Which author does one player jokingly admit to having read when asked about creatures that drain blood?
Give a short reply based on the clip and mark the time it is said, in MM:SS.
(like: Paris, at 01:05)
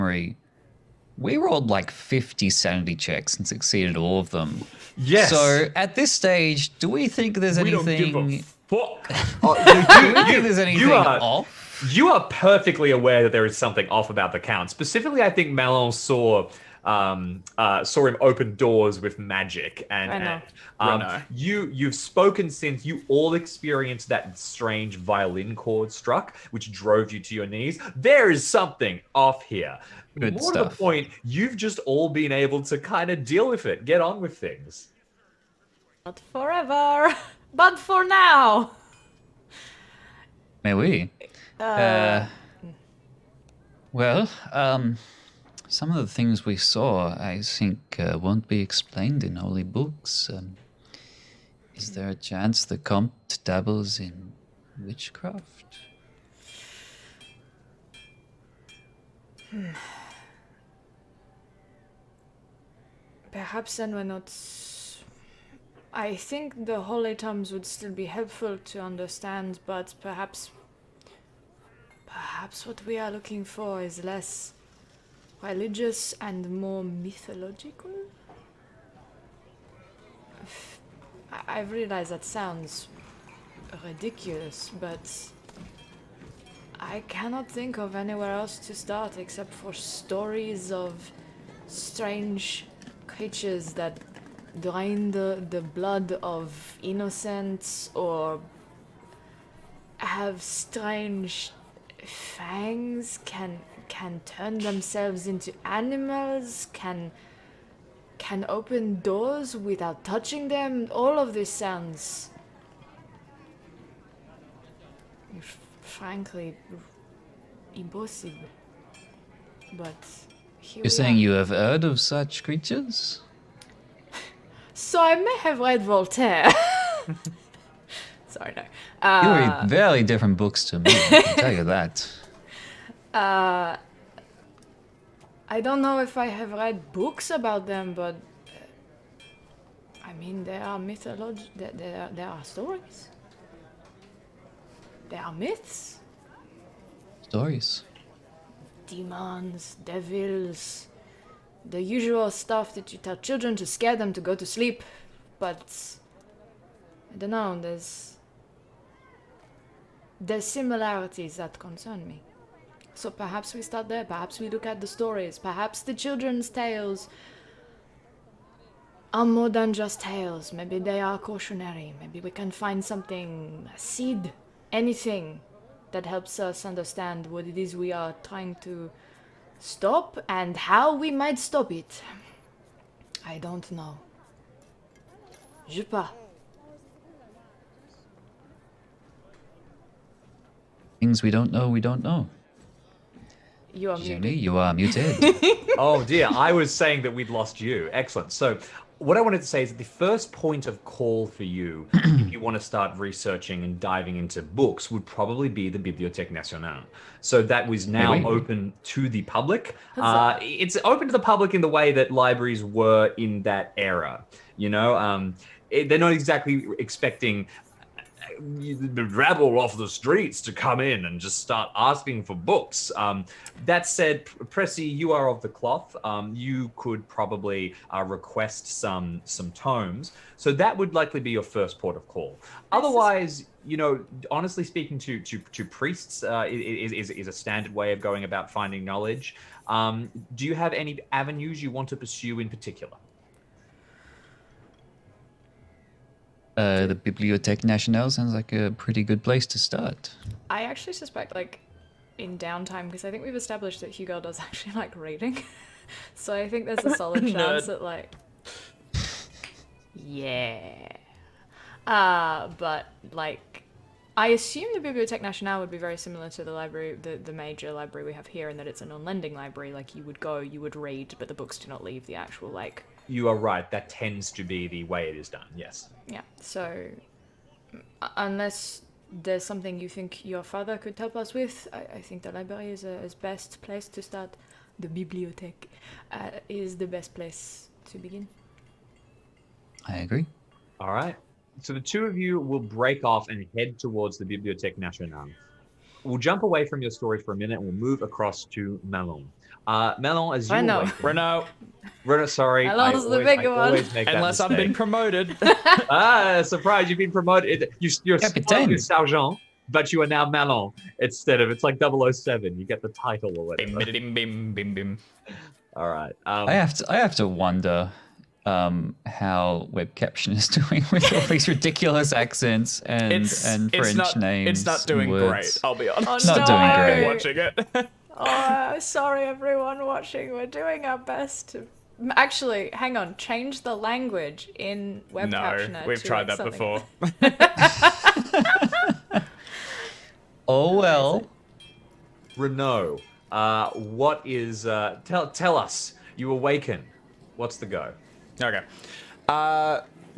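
Voltaire, at 02:05.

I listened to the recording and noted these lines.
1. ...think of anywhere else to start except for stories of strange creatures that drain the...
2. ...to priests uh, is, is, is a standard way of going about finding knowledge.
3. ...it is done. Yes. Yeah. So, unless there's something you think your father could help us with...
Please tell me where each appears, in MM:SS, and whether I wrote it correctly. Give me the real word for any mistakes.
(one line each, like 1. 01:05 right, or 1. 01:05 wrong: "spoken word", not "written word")
1. 01:27 right
2. 03:55 right
3. 04:35 right.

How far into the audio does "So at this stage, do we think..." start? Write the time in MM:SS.
00:05.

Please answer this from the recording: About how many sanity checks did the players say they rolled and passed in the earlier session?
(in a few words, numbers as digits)
50.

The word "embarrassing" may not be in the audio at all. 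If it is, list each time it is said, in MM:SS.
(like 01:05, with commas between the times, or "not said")
not said.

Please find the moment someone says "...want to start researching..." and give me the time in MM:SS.
03:22.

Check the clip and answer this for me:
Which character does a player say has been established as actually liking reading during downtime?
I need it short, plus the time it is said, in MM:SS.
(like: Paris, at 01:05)
Hugo, at 04:13.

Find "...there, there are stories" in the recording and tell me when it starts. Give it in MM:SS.
02:21.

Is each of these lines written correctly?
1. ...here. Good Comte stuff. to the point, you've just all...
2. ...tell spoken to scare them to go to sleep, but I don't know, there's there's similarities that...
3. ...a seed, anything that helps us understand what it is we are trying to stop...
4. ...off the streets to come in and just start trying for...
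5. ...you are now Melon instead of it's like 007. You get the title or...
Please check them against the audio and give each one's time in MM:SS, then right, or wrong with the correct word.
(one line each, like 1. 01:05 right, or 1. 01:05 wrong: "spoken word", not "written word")
1. 00:29 wrong: "More", not "Comte"
2. 02:32 wrong: "children", not "spoken"
3. 02:53 right
4. 03:39 wrong: "asking", not "trying"
5. 05:09 right.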